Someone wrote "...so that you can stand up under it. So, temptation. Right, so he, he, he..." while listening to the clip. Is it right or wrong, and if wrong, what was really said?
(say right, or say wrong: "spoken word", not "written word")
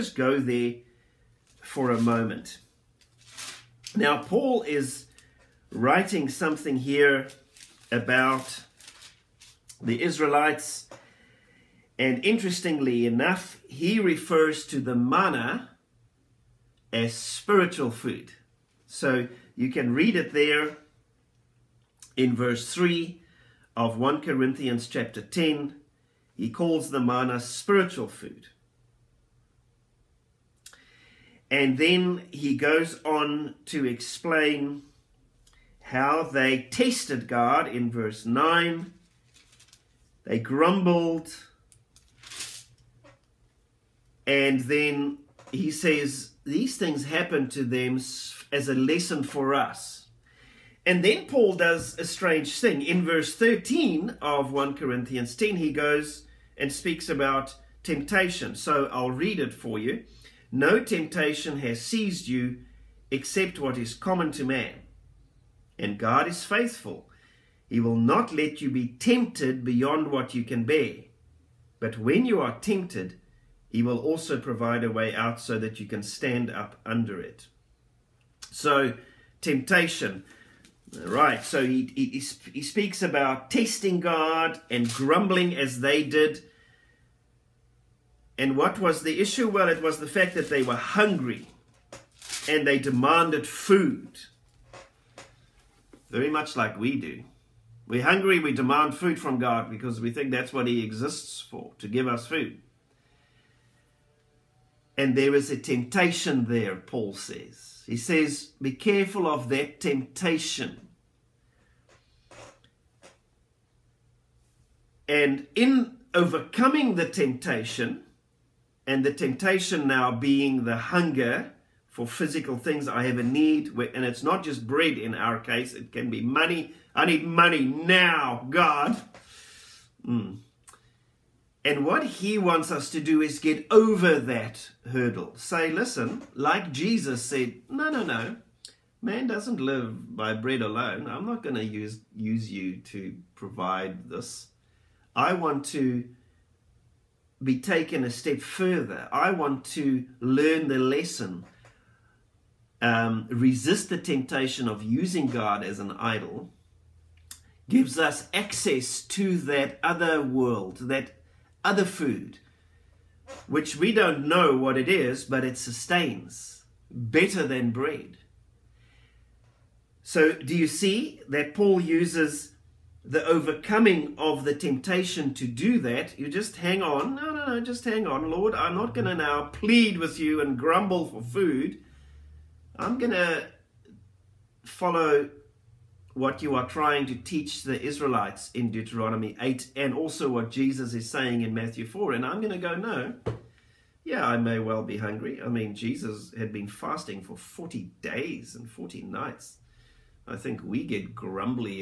right.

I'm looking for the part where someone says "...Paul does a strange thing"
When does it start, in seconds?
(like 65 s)
51 s.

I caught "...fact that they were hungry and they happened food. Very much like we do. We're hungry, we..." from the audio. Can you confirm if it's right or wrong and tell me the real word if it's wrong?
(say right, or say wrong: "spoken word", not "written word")
wrong: "demanded", not "happened".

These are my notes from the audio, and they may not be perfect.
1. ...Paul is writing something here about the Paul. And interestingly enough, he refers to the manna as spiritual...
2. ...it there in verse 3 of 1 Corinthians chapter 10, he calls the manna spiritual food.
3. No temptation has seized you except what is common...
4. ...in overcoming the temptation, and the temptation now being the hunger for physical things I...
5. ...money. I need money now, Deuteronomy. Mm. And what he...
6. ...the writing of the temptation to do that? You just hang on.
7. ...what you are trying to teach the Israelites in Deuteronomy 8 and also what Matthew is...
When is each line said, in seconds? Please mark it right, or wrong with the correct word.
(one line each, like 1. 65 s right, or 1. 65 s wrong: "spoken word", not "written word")
1. 4 s wrong: "Israelites", not "Paul"
2. 20 s right
3. 60 s right
4. 115 s right
5. 126 s wrong: "God", not "Deuteronomy"
6. 173 s wrong: "overcoming", not "writing"
7. 186 s wrong: "Jesus", not "Matthew".